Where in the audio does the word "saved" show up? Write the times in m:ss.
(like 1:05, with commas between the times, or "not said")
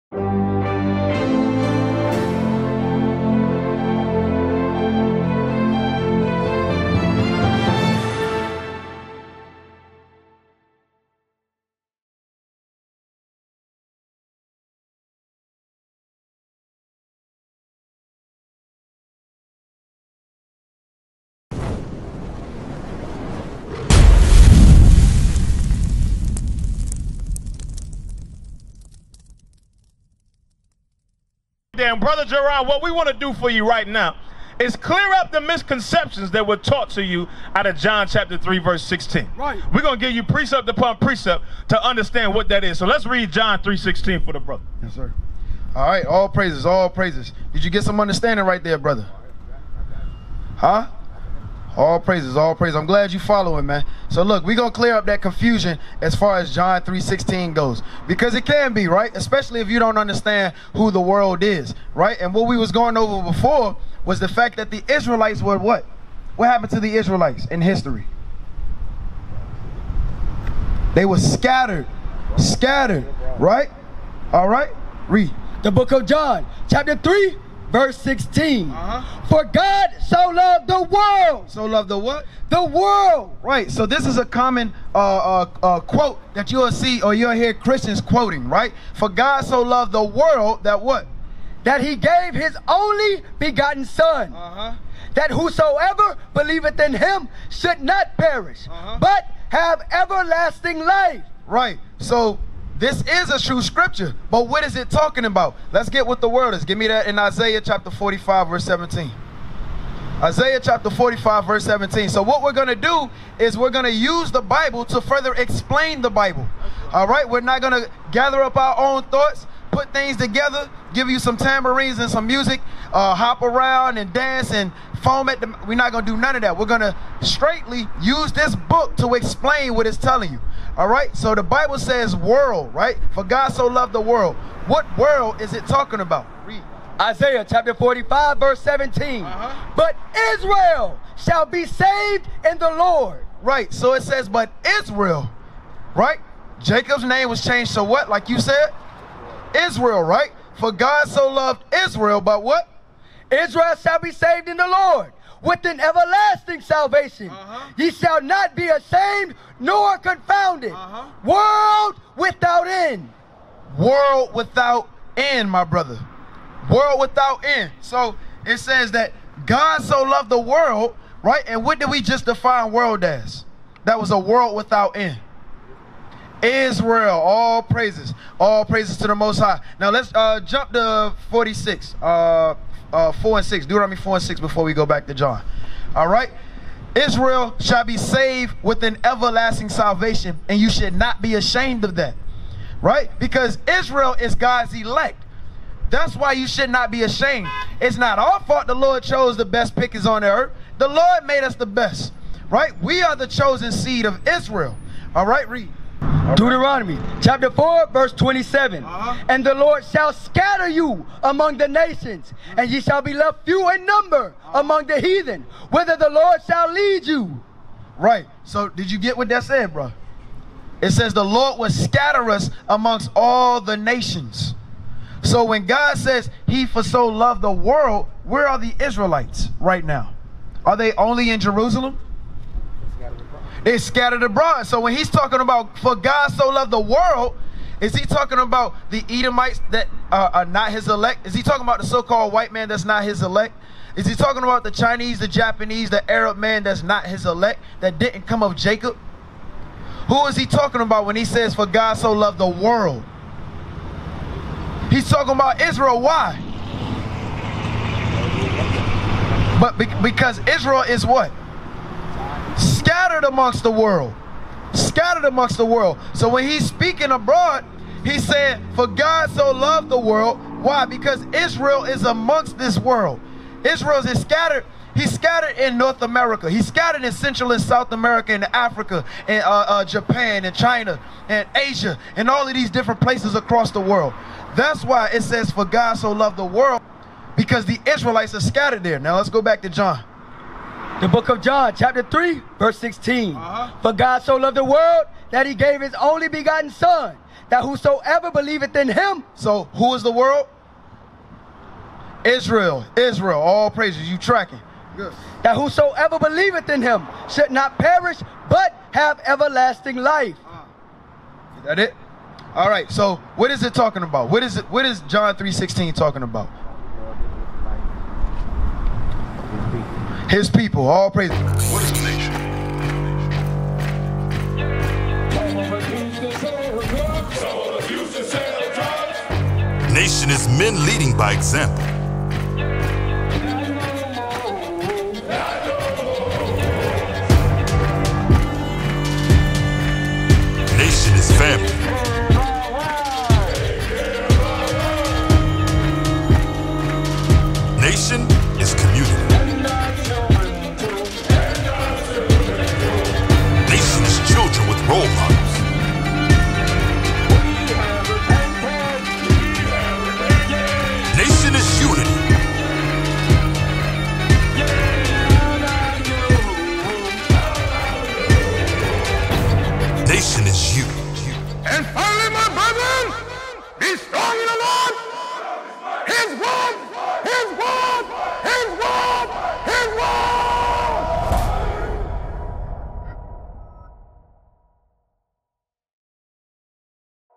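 2:21, 2:34, 3:07.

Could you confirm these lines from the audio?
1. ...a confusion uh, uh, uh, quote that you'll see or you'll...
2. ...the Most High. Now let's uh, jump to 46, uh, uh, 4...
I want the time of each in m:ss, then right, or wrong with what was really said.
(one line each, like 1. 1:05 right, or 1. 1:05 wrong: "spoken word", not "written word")
1. 1:24 wrong: "common", not "confusion"
2. 2:59 right.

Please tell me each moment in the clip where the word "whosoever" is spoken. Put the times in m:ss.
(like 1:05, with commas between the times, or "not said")
1:35, 4:57, 5:05.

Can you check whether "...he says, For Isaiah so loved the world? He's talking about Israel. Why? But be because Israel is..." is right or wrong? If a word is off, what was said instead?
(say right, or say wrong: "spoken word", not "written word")
wrong: "God", not "Isaiah".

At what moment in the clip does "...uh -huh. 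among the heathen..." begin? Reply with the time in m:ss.
3:34.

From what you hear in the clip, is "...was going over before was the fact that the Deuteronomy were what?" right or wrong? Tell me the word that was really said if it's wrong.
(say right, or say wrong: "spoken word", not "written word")
wrong: "Israelites", not "Deuteronomy".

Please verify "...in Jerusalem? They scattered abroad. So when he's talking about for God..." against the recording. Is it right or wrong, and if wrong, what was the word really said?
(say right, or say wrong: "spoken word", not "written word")
right.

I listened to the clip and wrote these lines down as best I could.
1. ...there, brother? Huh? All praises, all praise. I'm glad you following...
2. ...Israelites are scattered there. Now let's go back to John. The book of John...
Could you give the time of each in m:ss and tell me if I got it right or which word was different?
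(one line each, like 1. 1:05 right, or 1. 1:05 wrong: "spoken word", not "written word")
1. 0:48 right
2. 4:47 right.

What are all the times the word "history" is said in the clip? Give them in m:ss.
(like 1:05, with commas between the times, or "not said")
1:07.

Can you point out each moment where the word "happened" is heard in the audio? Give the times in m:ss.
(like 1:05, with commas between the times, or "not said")
1:06.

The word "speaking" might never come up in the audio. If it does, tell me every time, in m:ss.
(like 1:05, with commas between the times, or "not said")
4:26.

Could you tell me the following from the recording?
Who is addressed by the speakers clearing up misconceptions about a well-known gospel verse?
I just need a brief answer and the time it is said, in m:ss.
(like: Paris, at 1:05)
Gerard, at 0:32.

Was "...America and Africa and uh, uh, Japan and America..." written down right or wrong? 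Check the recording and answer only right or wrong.
wrong.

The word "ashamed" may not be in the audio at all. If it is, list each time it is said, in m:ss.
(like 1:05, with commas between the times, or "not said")
2:38, 3:11, 3:17.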